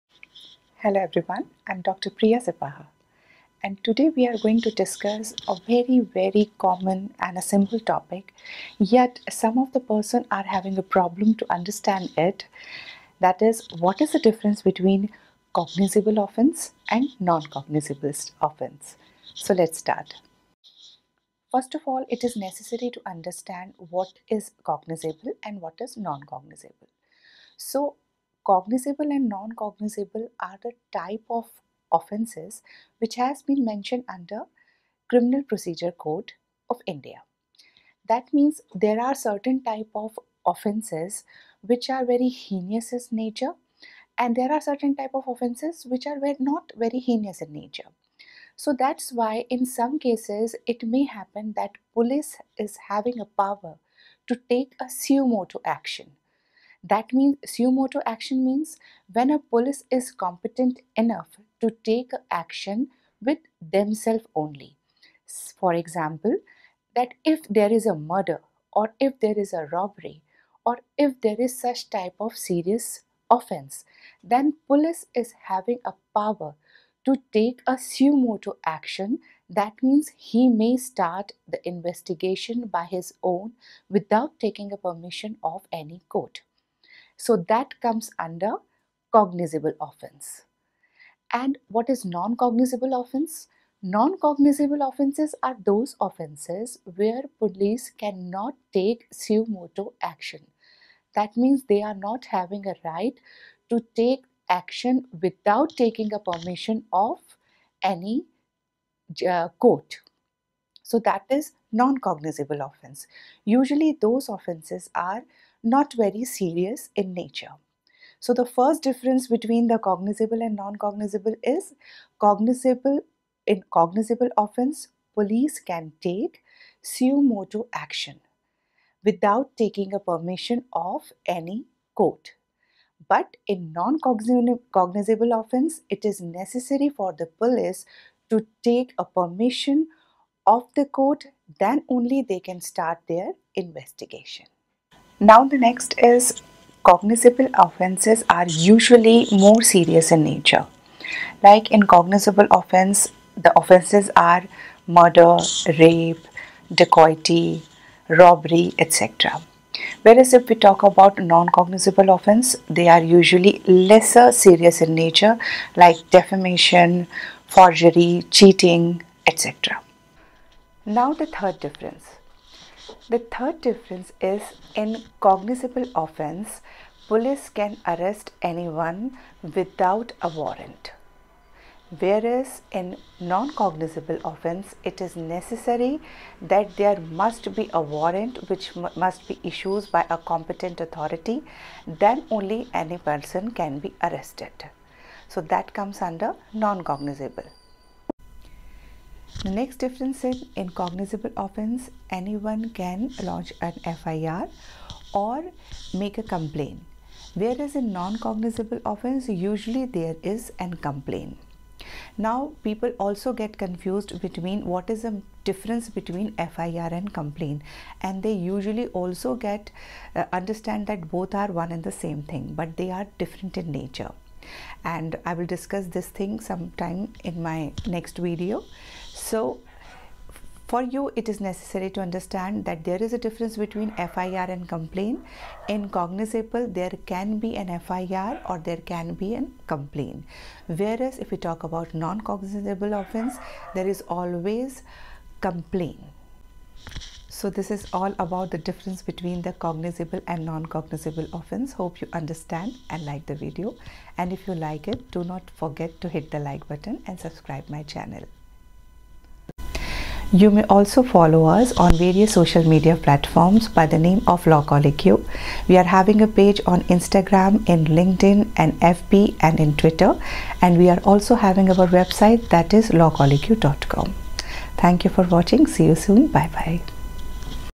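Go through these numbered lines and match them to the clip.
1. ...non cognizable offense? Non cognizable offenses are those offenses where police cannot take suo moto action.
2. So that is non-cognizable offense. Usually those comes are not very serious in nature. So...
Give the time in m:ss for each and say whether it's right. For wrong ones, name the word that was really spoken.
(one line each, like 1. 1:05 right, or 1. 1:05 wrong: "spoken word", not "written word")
1. 1:32 right
2. 1:50 wrong: "offenses", not "comes".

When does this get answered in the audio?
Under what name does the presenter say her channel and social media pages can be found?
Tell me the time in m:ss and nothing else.
4:24.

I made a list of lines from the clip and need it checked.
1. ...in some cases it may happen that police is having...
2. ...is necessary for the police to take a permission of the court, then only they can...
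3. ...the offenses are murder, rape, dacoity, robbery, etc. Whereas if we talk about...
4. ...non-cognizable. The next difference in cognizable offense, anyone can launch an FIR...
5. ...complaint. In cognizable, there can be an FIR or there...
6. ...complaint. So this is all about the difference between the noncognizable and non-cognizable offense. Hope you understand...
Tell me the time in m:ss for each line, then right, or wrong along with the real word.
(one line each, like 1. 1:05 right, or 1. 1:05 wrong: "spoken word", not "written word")
1. 0:49 right
2. 2:16 right
3. 2:33 right
4. 3:16 right
5. 3:54 right
6. 4:05 wrong: "cognizable", not "noncognizable".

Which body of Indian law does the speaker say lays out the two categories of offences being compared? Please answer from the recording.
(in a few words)
Criminal Procedure Code.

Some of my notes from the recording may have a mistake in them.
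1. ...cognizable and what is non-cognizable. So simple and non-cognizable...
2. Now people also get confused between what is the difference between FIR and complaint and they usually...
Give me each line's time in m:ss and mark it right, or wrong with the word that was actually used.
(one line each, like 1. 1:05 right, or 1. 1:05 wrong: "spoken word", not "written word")
1. 0:24 wrong: "cognizable", not "simple"
2. 3:32 right.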